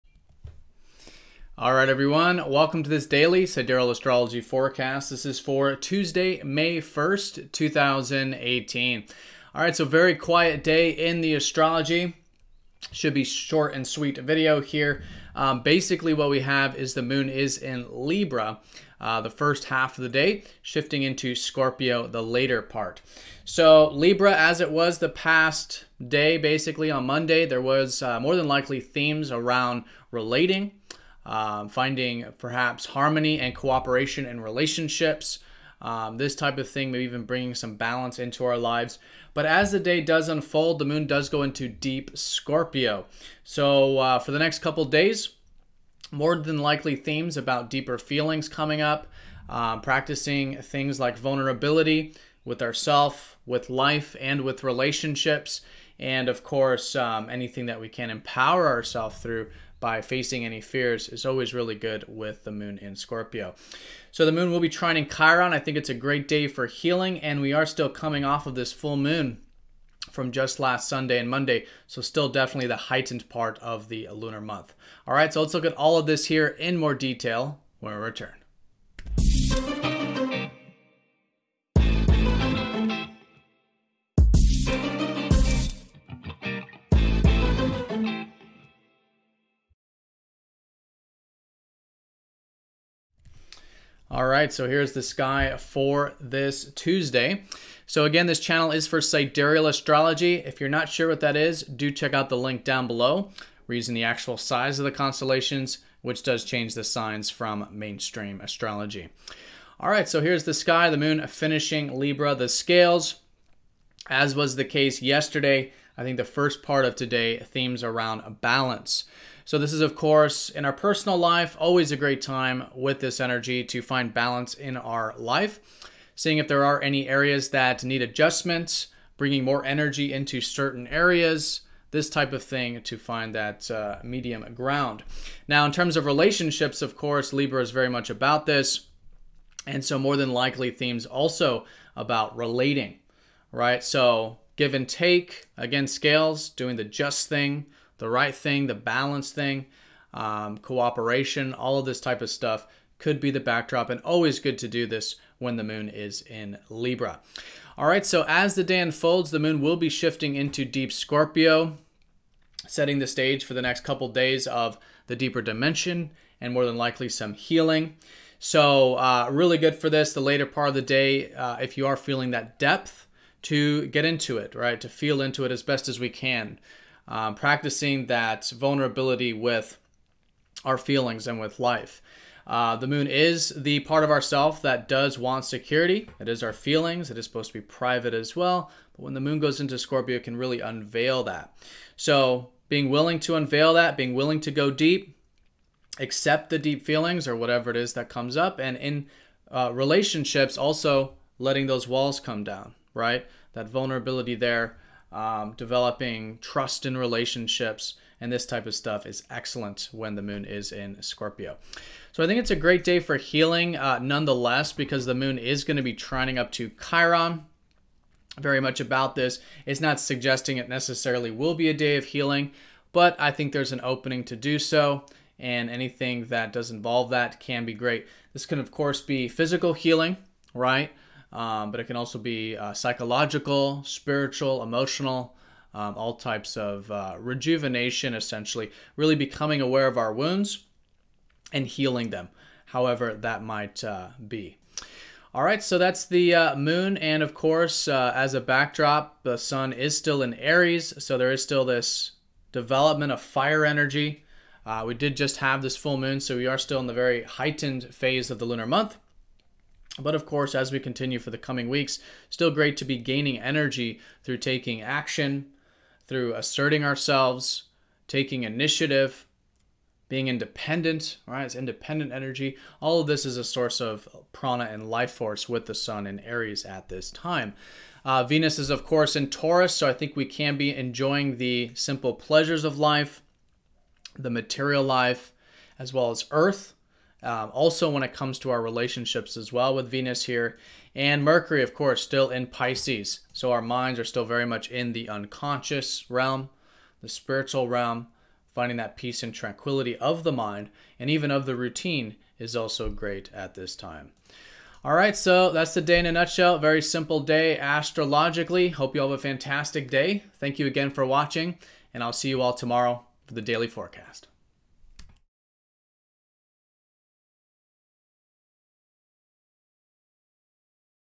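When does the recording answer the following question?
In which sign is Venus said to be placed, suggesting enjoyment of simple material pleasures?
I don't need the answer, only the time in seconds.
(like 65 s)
279 s.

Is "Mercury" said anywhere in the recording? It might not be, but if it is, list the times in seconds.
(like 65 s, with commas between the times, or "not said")
291 s.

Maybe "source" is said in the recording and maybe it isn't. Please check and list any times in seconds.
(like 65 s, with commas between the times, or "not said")
273 s.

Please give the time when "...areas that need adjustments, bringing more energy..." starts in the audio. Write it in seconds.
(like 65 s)
127 s.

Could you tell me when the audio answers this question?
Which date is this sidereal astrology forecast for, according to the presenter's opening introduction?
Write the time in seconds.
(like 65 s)
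5 s.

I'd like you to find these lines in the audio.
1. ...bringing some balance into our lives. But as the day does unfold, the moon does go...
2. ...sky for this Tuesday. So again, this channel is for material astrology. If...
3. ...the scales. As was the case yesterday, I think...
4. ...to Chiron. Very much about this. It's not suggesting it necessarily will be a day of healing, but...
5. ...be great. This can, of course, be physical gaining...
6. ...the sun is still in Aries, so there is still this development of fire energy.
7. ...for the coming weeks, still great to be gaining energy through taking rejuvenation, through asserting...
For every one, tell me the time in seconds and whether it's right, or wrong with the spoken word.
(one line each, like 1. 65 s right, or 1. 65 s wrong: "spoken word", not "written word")
1. 37 s right
2. 95 s wrong: "sidereal", not "material"
3. 112 s right
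4. 216 s right
5. 227 s wrong: "healing", not "gaining"
6. 249 s right
7. 261 s wrong: "action", not "rejuvenation".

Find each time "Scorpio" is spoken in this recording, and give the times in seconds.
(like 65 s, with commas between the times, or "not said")
21 s, 42 s, 62 s, 160 s, 189 s, 211 s.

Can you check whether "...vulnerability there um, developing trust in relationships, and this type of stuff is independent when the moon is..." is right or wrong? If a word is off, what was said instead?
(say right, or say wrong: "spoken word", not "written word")
wrong: "excellent", not "independent".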